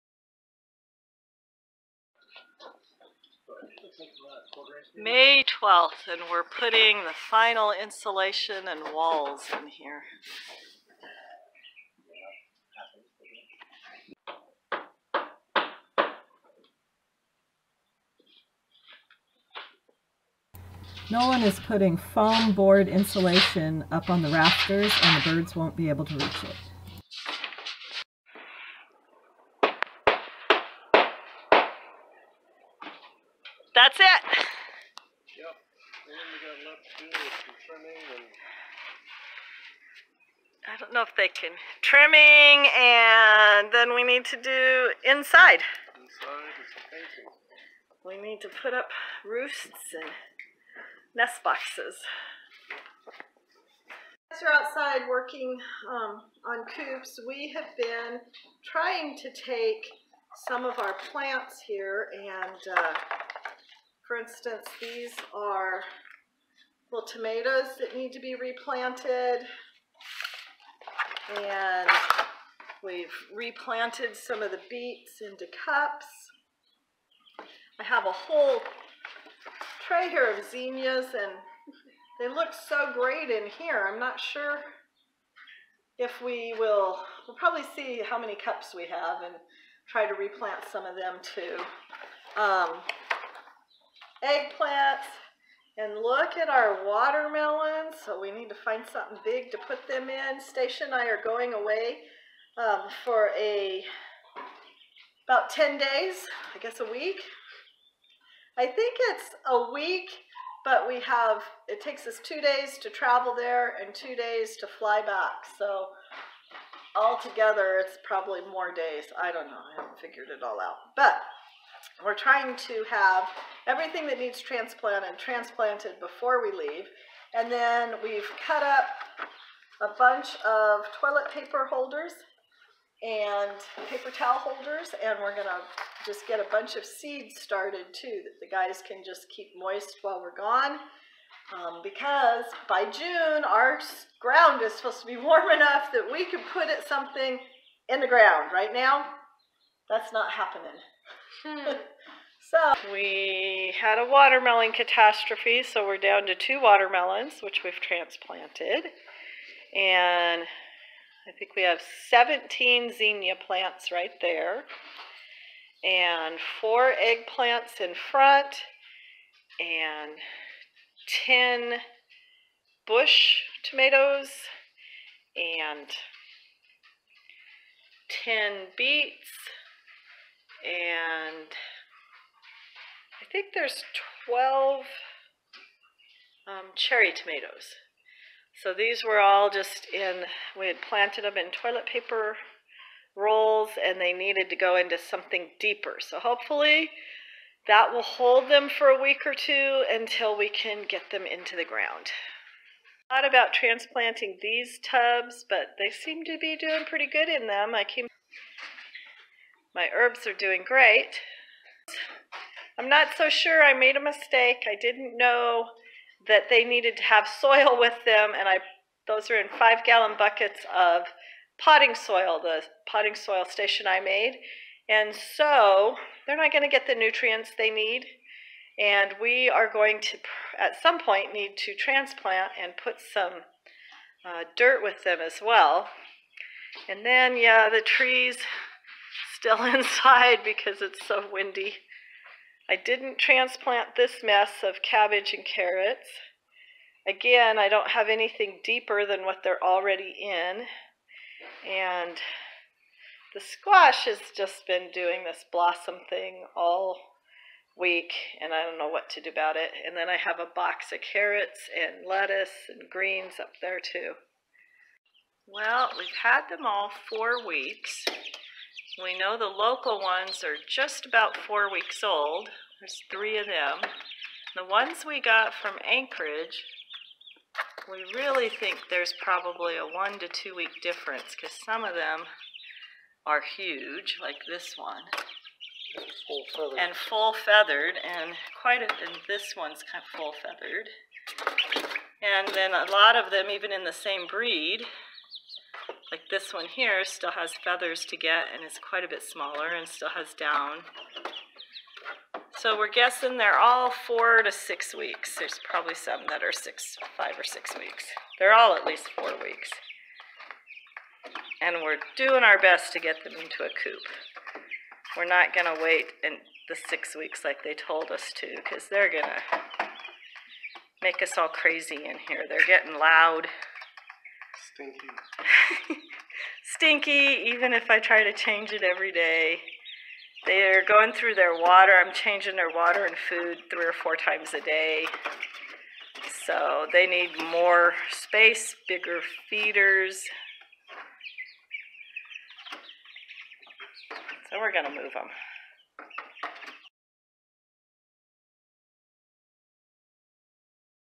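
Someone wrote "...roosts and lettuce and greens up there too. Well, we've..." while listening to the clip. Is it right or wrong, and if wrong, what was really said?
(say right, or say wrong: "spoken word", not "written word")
wrong: "carrots", not "roosts".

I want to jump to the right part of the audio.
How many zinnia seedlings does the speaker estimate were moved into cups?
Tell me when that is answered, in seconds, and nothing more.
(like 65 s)
162 s.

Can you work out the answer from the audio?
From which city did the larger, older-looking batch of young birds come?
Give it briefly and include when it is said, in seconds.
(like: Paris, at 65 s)
Anchorage, at 275 s.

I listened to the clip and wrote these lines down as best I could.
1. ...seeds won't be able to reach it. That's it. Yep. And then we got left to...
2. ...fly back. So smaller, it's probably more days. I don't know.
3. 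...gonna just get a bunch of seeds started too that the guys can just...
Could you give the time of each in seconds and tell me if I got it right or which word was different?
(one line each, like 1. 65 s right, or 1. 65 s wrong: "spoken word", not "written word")
1. 25 s wrong: "birds", not "seeds"
2. 114 s wrong: "altogether", not "smaller"
3. 135 s right.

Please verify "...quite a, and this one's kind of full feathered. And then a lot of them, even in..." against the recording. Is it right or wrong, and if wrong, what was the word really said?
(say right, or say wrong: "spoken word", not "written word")
right.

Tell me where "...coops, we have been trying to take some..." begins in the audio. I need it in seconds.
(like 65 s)
56 s.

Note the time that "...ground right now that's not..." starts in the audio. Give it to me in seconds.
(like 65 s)
148 s.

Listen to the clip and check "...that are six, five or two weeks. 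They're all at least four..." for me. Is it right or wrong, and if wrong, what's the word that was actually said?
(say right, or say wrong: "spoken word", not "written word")
wrong: "six", not "two".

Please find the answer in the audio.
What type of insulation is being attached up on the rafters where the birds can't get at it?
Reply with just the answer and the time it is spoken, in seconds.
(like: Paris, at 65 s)
Foam board, at 21 s.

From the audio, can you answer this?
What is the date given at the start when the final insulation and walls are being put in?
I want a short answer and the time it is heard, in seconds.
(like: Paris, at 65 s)
May 12th, at 4 s.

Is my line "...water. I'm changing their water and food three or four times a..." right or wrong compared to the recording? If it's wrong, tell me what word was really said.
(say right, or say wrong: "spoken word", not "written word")
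right.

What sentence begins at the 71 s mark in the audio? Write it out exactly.
And we've replanted some of the beets into cups.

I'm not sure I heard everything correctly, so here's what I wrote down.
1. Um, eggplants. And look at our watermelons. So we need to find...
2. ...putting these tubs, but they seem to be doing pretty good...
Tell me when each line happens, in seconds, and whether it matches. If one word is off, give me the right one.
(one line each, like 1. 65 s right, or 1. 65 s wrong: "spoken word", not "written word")
1. 92 s right
2. 203 s wrong: "transplanting", not "putting".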